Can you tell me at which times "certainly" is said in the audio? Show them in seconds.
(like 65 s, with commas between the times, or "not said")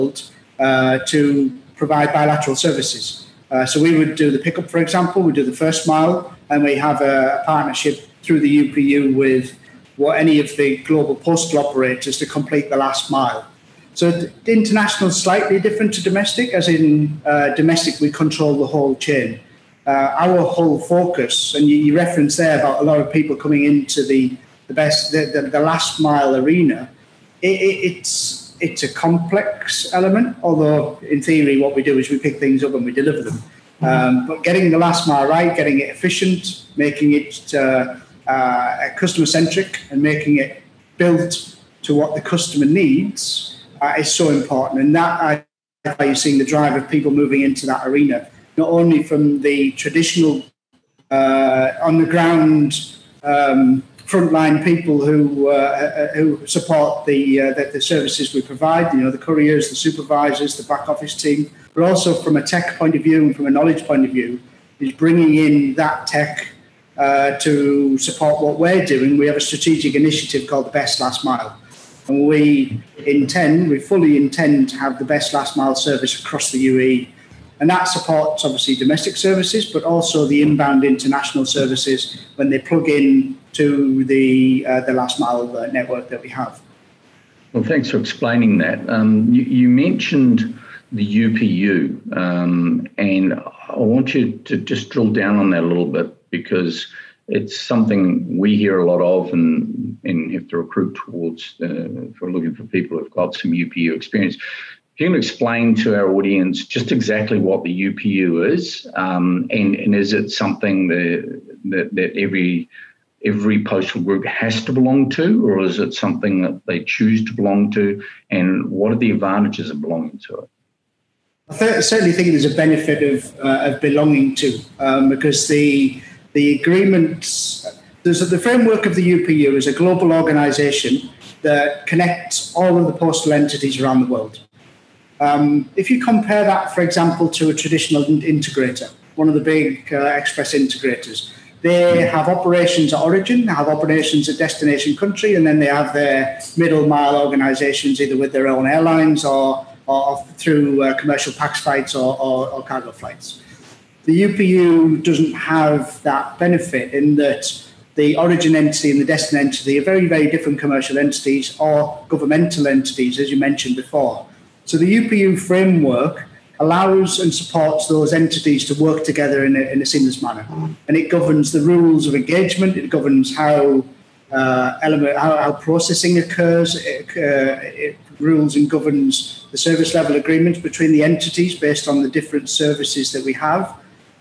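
121 s.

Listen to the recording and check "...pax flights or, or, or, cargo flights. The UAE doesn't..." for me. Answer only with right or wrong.
wrong.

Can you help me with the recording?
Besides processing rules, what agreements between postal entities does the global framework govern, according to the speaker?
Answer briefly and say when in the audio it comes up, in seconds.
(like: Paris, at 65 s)
Service level agreements, at 179 s.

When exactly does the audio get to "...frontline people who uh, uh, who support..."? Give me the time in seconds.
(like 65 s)
54 s.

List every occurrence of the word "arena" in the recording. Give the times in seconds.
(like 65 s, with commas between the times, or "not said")
26 s, 47 s.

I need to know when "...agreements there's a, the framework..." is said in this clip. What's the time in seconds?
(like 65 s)
126 s.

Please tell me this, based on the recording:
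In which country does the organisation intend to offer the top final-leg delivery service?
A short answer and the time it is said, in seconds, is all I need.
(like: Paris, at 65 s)
UAE, at 76 s.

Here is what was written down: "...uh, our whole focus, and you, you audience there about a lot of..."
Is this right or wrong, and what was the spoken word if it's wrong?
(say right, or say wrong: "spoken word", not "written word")
wrong: "reference", not "audience".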